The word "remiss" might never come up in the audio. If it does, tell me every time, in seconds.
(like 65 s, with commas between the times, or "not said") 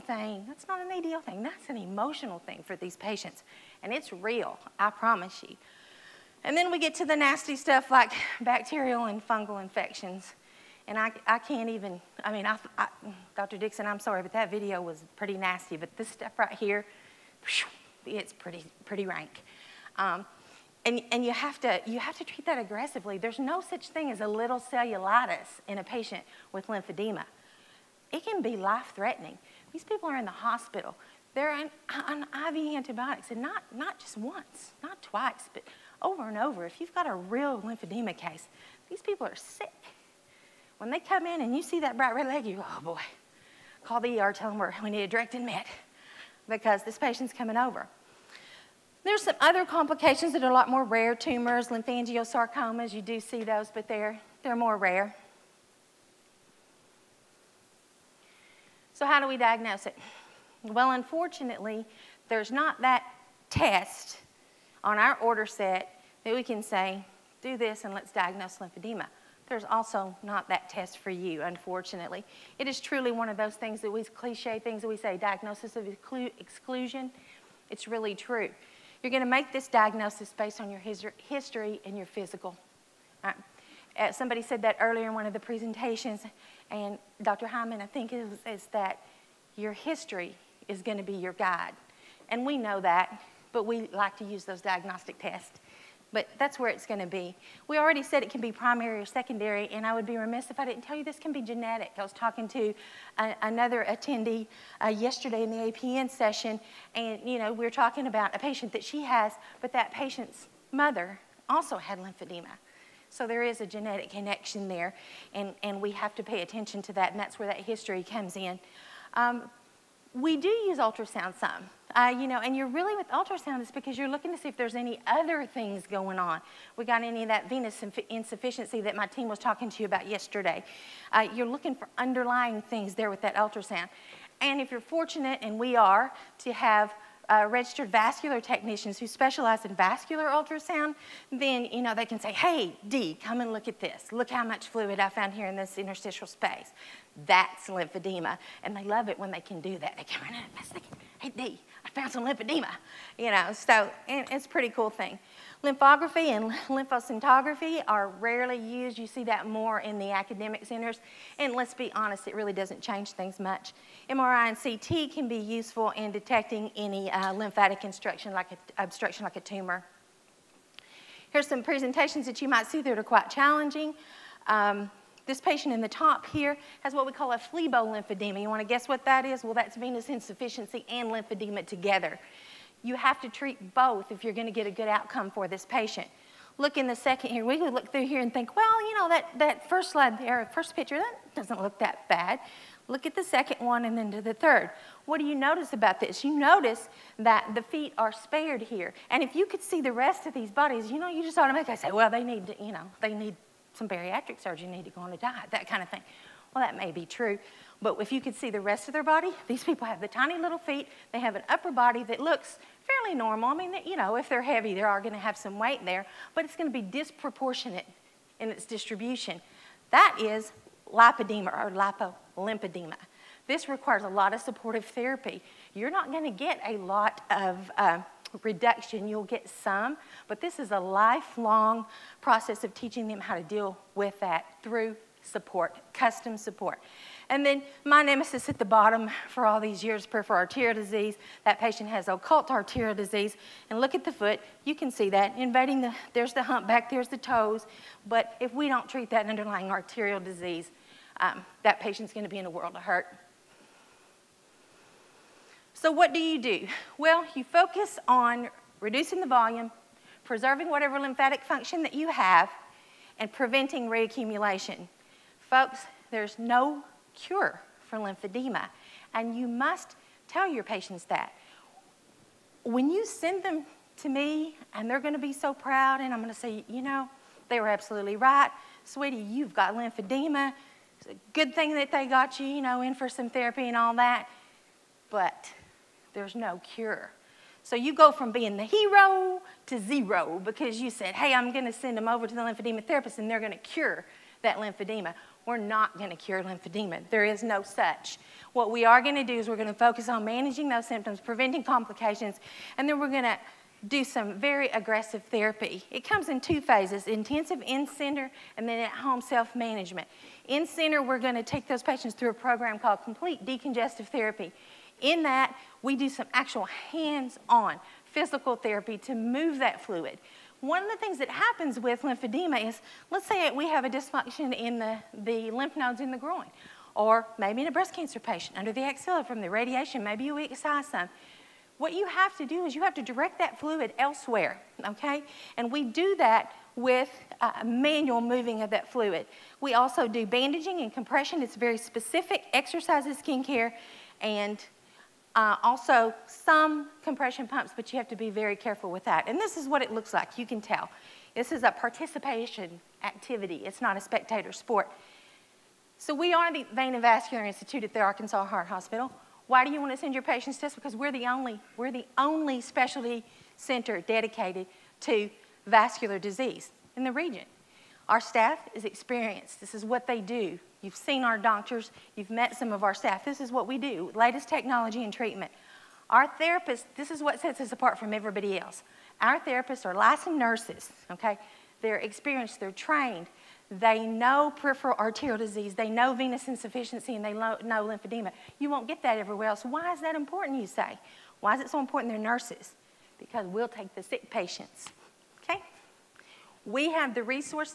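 100 s.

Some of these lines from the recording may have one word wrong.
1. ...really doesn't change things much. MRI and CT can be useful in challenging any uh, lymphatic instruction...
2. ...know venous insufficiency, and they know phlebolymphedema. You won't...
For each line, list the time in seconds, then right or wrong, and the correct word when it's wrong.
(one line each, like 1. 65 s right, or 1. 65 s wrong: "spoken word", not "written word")
1. 162 s wrong: "detecting", not "challenging"
2. 385 s wrong: "lymphedema", not "phlebolymphedema".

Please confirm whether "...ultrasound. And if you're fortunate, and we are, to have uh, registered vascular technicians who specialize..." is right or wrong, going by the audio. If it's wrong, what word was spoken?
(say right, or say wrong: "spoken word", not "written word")
right.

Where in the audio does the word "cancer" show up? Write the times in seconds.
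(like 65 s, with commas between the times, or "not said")
327 s.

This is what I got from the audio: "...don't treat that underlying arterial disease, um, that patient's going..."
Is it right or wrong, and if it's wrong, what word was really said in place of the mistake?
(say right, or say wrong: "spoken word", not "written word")
right.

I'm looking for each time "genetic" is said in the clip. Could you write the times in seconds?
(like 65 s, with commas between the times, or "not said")
101 s, 113 s.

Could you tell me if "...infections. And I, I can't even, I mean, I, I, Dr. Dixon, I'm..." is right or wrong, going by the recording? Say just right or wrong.
right.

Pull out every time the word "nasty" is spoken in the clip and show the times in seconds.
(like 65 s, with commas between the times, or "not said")
7 s, 15 s.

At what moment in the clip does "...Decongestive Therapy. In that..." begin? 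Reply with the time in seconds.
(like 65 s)
313 s.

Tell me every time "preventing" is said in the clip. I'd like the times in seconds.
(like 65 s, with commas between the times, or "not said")
263 s, 301 s.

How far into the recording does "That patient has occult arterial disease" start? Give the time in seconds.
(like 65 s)
241 s.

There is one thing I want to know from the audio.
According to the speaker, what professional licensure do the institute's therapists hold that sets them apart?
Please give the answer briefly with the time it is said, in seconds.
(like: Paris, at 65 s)
licensed nurses, at 379 s.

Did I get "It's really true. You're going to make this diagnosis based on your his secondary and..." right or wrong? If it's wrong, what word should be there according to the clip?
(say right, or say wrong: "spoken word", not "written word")
wrong: "history", not "secondary".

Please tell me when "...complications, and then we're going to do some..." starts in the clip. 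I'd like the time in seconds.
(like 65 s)
301 s.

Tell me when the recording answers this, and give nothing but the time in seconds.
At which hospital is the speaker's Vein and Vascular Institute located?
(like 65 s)
358 s.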